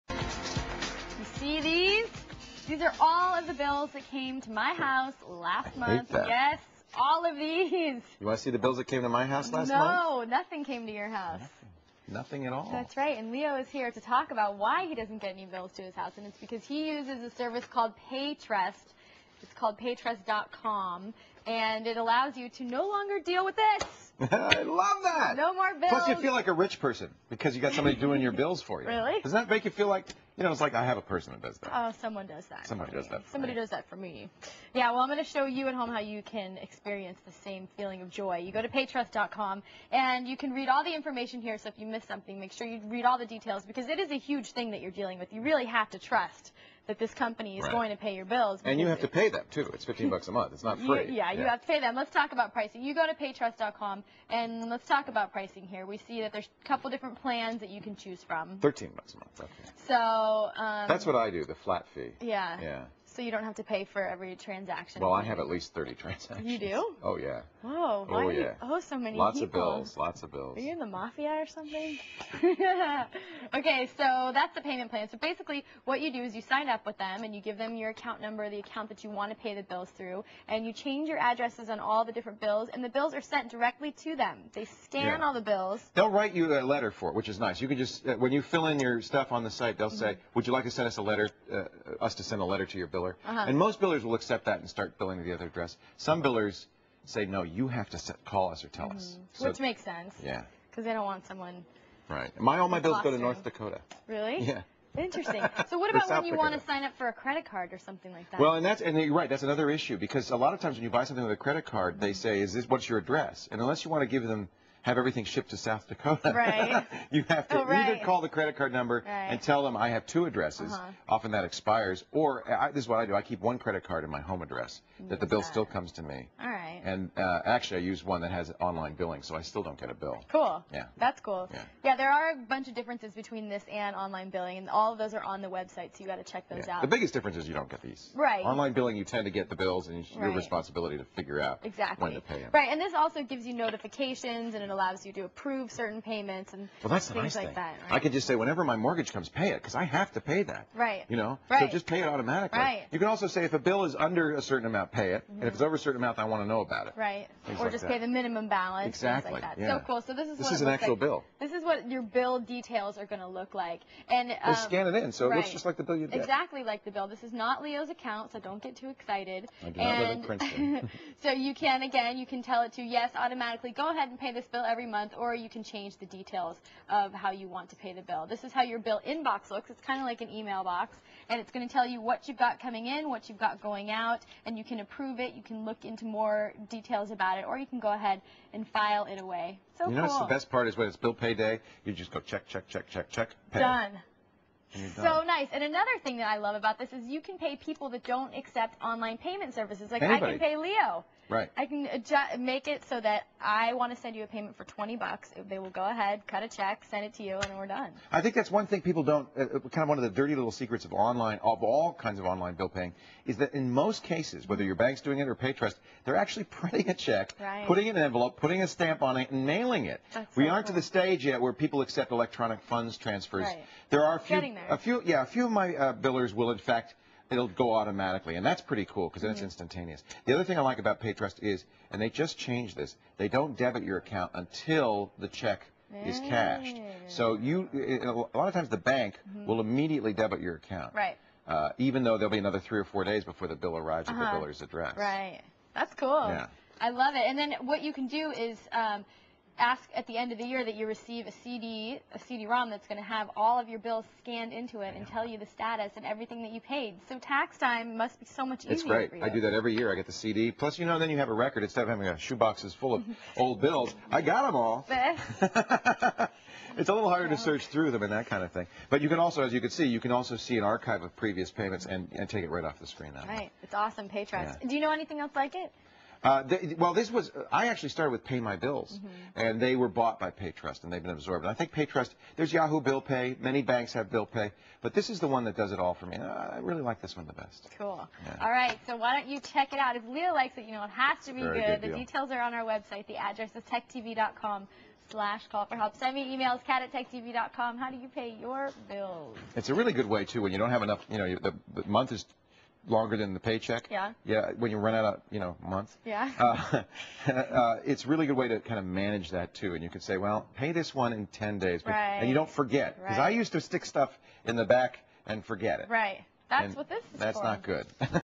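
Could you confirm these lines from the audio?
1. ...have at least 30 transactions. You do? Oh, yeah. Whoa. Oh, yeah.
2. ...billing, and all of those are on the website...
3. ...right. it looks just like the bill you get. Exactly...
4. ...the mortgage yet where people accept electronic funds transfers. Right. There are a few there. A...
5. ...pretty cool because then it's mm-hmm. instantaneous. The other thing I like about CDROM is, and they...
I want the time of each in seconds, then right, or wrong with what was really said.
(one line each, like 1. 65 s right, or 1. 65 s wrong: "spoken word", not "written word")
1. 65 s right
2. 134 s right
3. 165 s right
4. 220 s wrong: "stage", not "mortgage"
5. 228 s wrong: "PayTrust", not "CDROM".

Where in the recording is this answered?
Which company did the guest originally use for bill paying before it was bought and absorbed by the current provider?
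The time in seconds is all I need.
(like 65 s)
278 s.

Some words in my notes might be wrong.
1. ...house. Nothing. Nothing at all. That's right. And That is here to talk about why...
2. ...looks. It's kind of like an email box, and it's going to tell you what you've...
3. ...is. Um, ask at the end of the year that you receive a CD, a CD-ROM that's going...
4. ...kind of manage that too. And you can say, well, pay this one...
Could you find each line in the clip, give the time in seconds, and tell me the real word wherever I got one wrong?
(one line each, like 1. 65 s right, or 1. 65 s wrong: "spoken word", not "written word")
1. 11 s wrong: "Leo", not "That"
2. 179 s right
3. 248 s right
4. 308 s right.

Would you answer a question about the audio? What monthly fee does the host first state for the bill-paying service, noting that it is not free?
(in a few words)
$15.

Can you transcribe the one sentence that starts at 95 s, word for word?
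Some billers say, no, you have to set, call us or tell mm -hmm.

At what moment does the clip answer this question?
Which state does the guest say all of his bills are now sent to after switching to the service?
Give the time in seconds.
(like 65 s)
103 s.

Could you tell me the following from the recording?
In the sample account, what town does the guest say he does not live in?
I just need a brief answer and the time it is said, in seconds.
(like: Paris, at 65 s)
Princeton, at 170 s.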